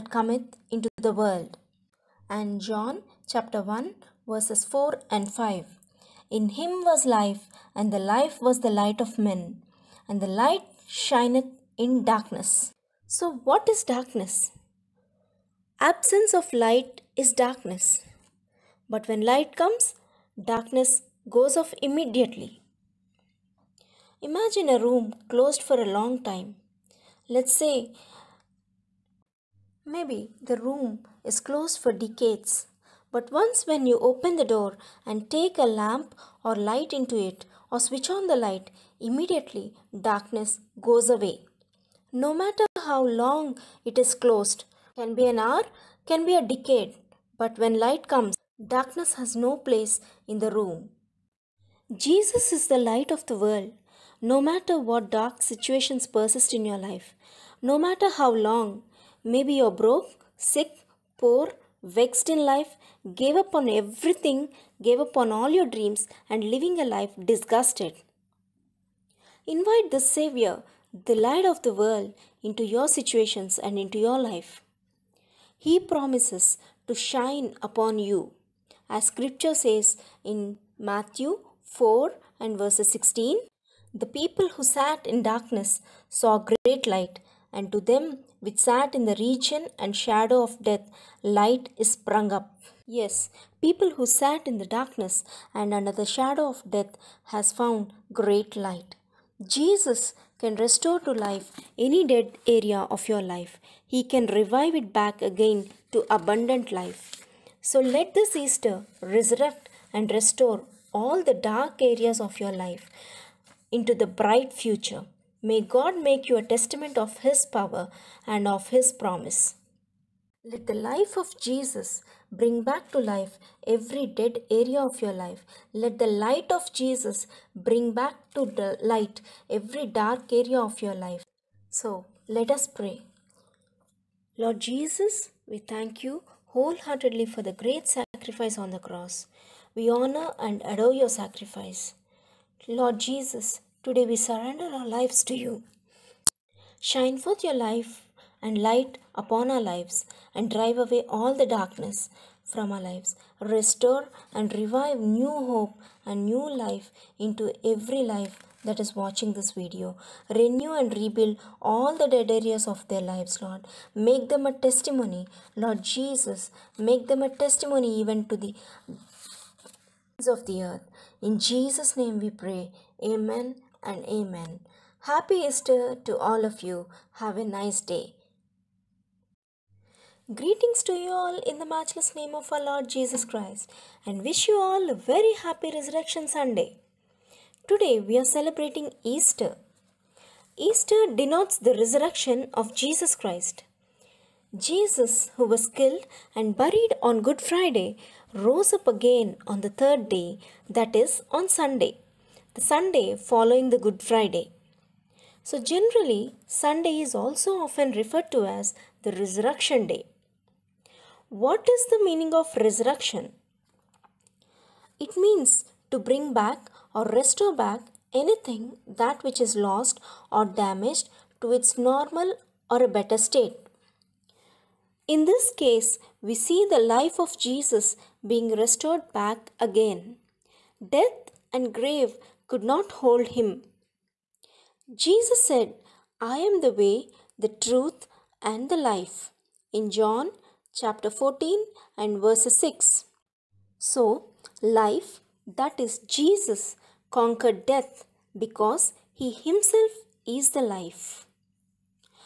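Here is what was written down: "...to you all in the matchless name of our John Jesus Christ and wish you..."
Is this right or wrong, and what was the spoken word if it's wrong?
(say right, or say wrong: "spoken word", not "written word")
wrong: "Lord", not "John".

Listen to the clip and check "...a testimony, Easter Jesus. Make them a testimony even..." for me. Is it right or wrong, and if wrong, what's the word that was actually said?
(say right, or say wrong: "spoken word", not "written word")
wrong: "Lord", not "Easter".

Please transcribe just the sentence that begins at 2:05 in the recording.
Let the light of Jesus bring back to the light every dark area of your life.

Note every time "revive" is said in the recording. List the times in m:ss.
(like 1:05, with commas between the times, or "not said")
1:44, 2:34.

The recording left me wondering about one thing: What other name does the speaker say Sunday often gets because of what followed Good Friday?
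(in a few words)
Resurrection Day.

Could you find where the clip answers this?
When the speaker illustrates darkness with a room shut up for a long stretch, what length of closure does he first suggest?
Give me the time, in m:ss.
0:31.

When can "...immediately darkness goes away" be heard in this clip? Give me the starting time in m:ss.
0:38.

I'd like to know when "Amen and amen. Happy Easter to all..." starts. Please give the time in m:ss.
2:53.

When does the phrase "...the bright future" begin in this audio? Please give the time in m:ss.
1:53.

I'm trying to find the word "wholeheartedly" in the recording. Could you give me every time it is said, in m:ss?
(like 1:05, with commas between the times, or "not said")
2:16.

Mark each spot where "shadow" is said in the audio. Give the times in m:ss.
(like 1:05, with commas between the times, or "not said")
1:29, 1:36.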